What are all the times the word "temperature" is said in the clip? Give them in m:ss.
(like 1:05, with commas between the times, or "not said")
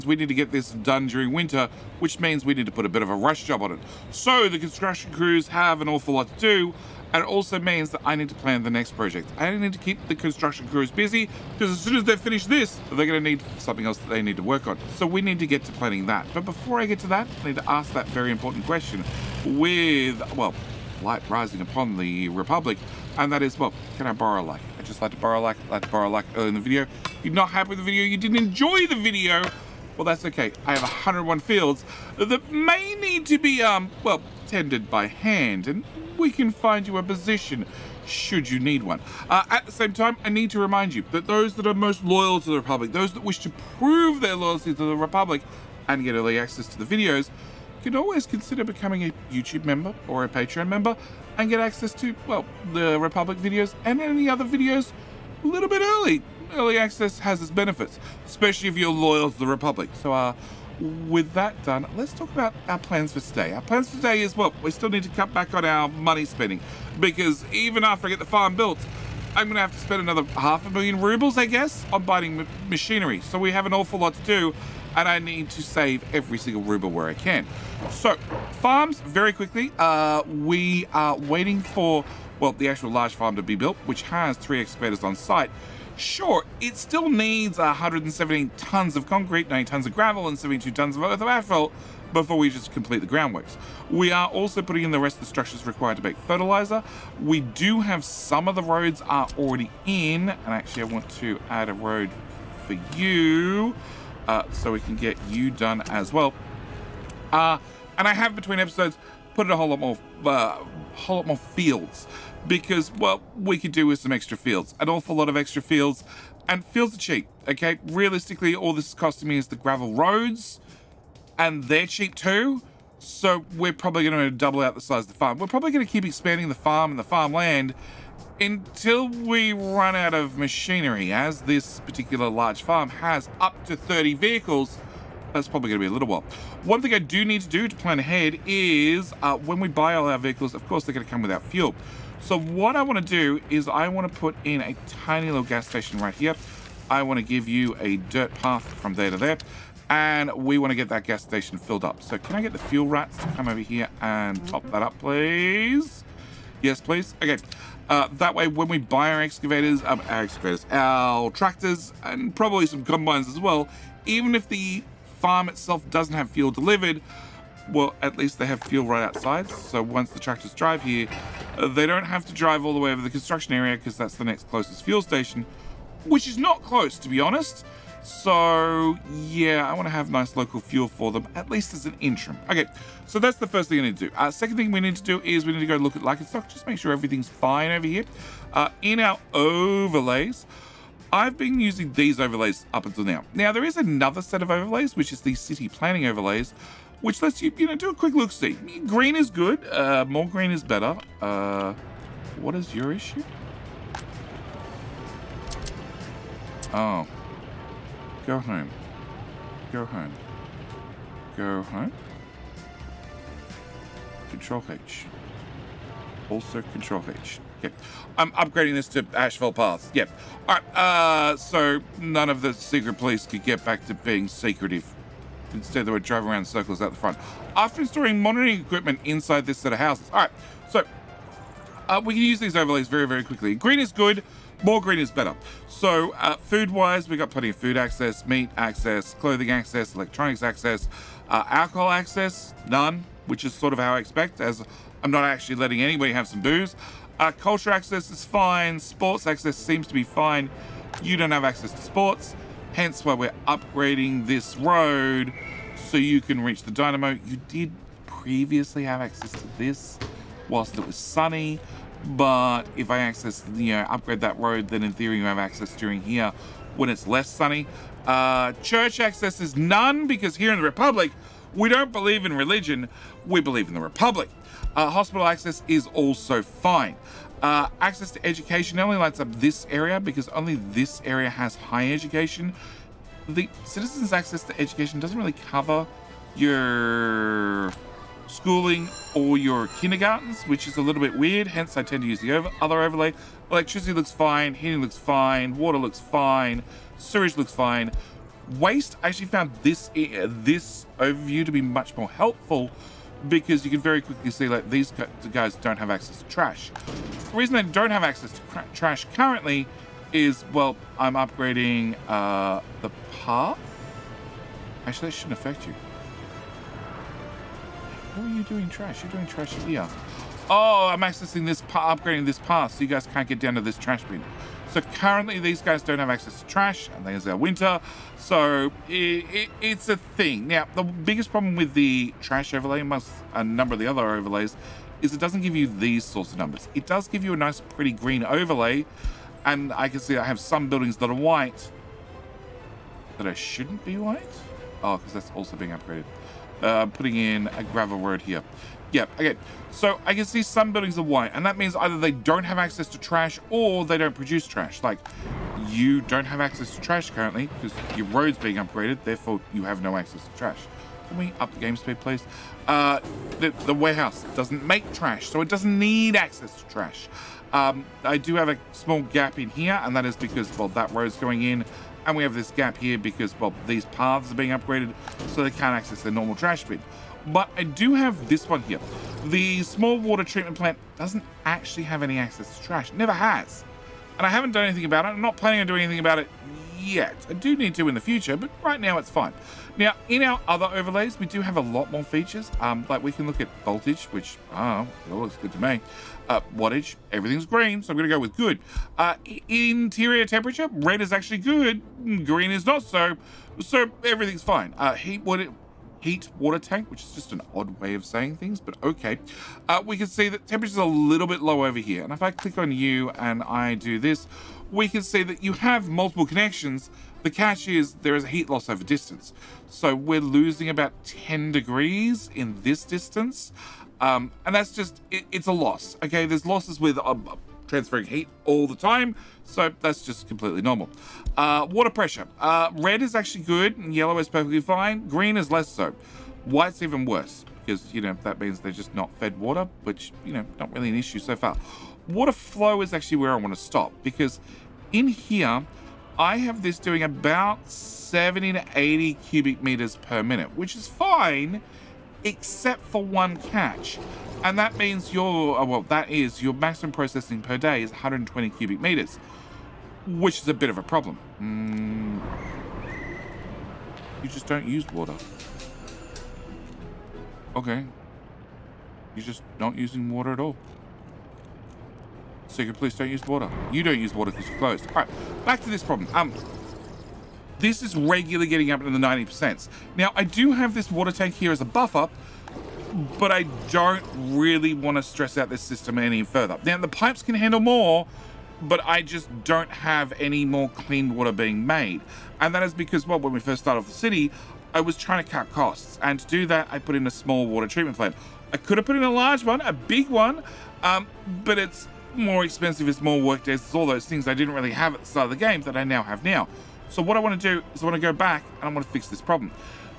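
6:40, 6:50.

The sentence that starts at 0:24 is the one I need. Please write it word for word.
I just like to borrow a like, like to borrow a like early in the video.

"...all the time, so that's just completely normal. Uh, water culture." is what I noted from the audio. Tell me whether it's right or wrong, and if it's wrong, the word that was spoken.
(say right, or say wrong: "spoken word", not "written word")
wrong: "pressure", not "culture".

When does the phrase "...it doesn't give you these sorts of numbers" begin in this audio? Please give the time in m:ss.
5:35.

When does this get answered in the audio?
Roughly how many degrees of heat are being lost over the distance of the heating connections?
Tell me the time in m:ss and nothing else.
7:01.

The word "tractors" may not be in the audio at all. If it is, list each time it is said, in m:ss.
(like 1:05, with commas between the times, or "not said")
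2:41, 2:50.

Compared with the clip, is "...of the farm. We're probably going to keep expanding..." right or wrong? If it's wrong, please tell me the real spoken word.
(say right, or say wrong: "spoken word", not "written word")
right.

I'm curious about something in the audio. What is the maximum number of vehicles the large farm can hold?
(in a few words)
30.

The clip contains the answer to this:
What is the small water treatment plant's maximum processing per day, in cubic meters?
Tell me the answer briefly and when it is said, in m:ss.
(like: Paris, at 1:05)
120, at 7:37.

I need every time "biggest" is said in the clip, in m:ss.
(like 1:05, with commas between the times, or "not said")
5:30.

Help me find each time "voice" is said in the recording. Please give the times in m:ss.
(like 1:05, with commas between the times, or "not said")
not said.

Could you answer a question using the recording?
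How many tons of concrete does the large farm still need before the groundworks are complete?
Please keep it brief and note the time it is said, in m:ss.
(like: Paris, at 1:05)
178, at 1:27.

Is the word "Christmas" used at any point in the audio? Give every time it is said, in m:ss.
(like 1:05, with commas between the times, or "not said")
not said.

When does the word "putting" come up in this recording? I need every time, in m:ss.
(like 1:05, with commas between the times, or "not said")
1:34, 5:46.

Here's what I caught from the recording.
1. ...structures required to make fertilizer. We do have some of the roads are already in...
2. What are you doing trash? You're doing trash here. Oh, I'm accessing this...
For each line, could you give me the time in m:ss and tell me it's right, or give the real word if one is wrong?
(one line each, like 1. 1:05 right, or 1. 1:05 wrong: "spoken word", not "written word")
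1. 1:35 right
2. 5:18 right.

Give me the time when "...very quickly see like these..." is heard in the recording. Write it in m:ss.
5:03.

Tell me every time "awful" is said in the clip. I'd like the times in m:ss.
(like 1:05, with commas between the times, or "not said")
0:05, 1:13, 1:54.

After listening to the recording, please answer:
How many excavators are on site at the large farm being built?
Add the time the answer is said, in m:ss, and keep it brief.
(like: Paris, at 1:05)
3, at 1:24.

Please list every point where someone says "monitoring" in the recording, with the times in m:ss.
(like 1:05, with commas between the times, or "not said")
3:48.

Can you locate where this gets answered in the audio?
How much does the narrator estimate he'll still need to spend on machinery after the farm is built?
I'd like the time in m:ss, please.
1:10.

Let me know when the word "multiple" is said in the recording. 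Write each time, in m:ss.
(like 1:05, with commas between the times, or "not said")
6:55.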